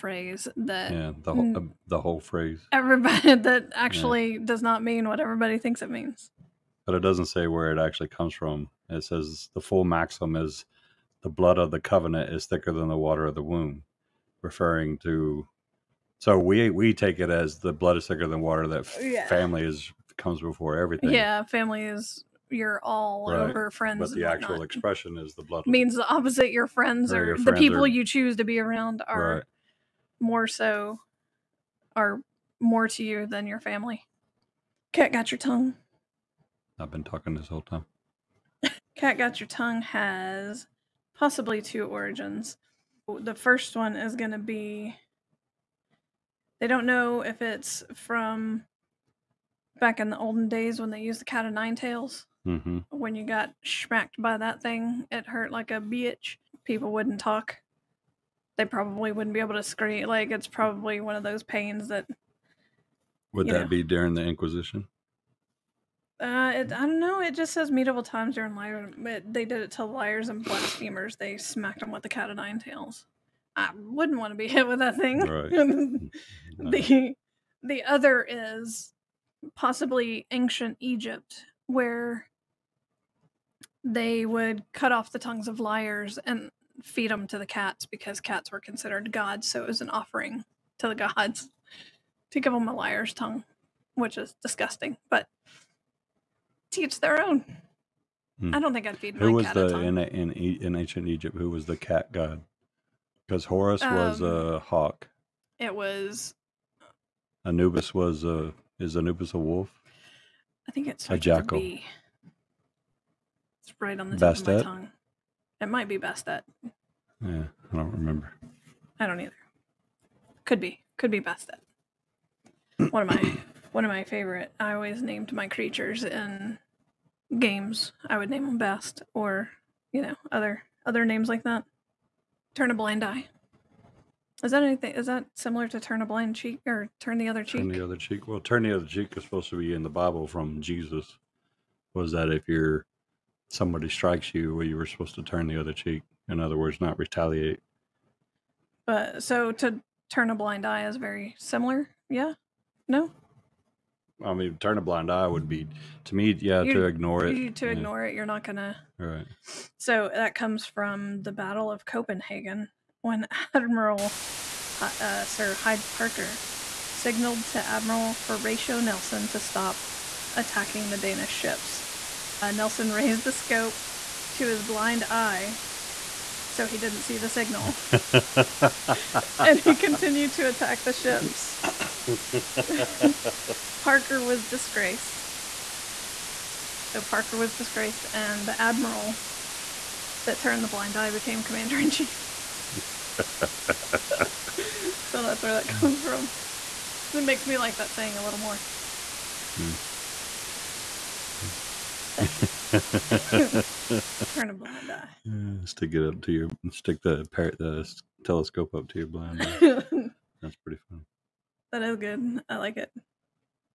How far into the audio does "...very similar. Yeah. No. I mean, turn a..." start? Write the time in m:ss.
2:30.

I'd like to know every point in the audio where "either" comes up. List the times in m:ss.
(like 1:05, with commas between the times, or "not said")
1:59.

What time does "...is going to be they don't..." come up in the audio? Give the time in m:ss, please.
0:43.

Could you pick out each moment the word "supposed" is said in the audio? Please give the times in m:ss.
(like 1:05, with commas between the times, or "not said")
2:19, 2:24.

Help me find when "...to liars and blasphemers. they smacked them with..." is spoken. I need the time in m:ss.
1:09.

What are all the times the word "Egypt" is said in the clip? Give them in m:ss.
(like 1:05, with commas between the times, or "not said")
1:20, 1:41.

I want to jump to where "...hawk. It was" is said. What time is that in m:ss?
1:44.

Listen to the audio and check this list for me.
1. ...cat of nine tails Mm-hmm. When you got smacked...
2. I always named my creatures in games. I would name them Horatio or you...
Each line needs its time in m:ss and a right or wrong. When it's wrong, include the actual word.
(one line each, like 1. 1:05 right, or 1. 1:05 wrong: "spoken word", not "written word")
1. 0:51 right
2. 2:04 wrong: "Bast", not "Horatio".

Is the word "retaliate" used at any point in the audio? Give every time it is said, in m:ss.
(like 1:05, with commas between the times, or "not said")
2:26.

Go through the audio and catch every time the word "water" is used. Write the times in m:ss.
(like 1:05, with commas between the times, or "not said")
0:12, 0:18.